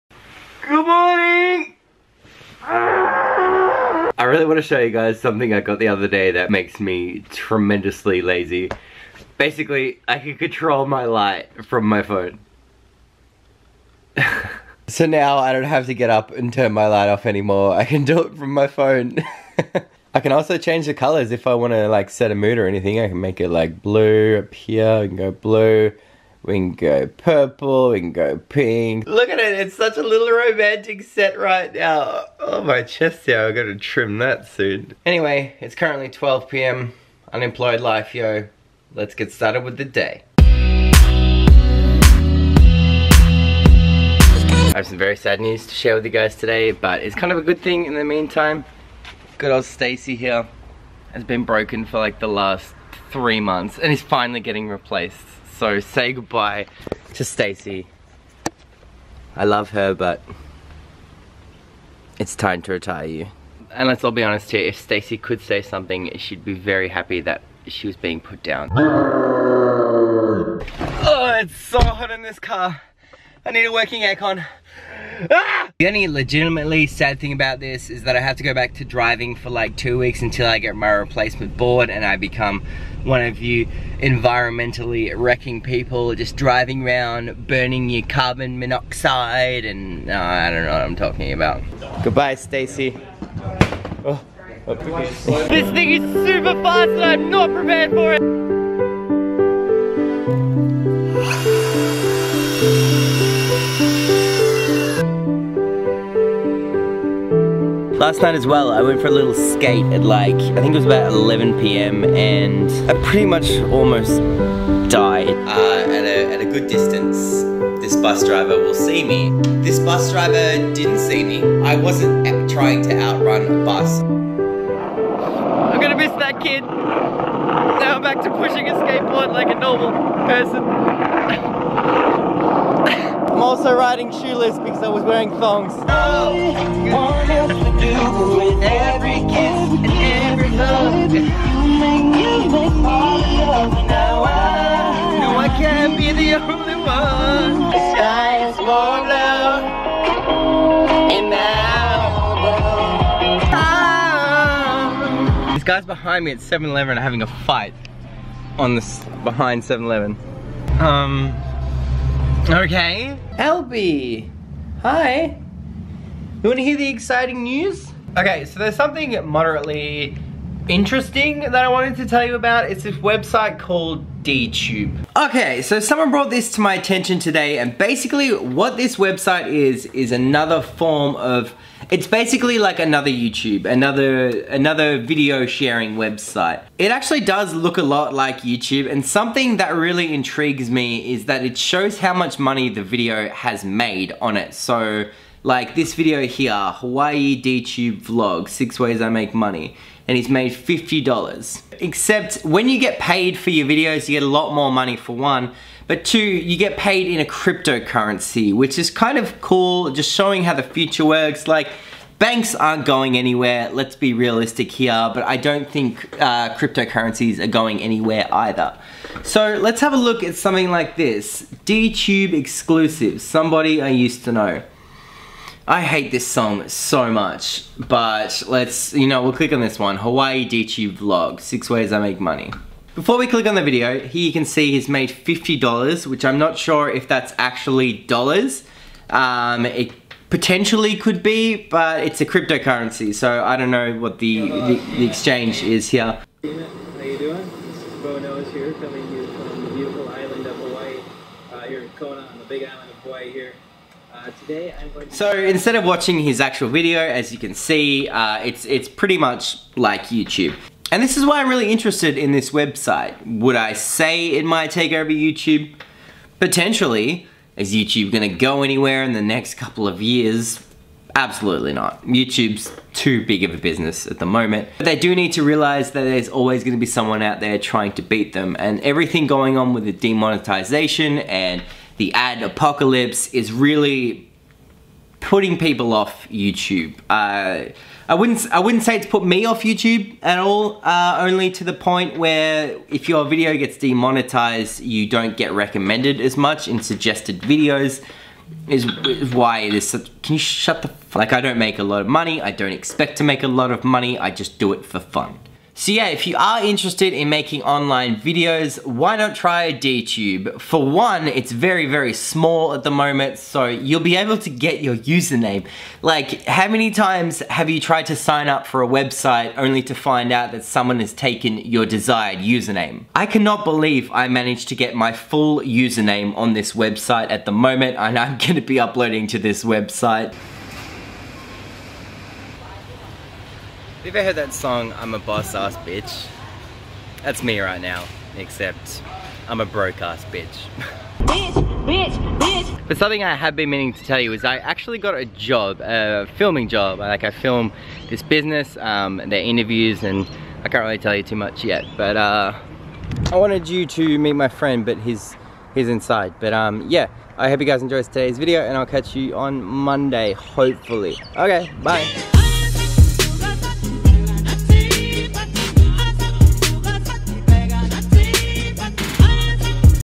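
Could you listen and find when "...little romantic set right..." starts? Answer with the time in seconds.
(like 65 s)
30 s.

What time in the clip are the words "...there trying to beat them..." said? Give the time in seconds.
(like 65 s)
277 s.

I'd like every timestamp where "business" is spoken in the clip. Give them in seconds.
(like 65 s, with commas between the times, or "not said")
273 s, 348 s.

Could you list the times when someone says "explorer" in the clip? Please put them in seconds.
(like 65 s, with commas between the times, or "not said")
not said.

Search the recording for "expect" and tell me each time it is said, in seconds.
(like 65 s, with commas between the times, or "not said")
302 s.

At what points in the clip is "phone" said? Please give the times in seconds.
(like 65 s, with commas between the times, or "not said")
12 s, 18 s.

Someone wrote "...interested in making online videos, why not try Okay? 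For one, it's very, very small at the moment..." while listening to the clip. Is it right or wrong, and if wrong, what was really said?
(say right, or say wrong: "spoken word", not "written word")
wrong: "DTube", not "Okay".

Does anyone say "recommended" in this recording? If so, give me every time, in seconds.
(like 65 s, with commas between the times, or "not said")
295 s.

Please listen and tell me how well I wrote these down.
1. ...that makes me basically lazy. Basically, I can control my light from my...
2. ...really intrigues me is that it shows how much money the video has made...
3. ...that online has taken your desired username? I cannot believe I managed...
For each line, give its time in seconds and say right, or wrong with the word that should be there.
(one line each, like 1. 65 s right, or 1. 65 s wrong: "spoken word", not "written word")
1. 6 s wrong: "tremendously", not "basically"
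2. 189 s right
3. 320 s wrong: "someone", not "online".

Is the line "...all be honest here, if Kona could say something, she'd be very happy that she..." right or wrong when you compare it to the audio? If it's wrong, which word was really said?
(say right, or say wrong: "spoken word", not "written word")
wrong: "Stacy", not "Kona".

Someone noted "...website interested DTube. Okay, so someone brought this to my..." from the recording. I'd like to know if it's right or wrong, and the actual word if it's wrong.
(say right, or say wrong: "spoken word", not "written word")
wrong: "called", not "interested".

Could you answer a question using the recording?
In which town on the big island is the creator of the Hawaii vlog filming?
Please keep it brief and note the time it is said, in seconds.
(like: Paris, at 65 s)
Kona, at 251 s.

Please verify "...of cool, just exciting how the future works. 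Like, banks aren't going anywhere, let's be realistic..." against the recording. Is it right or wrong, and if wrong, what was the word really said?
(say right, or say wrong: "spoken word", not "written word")
wrong: "showing", not "exciting".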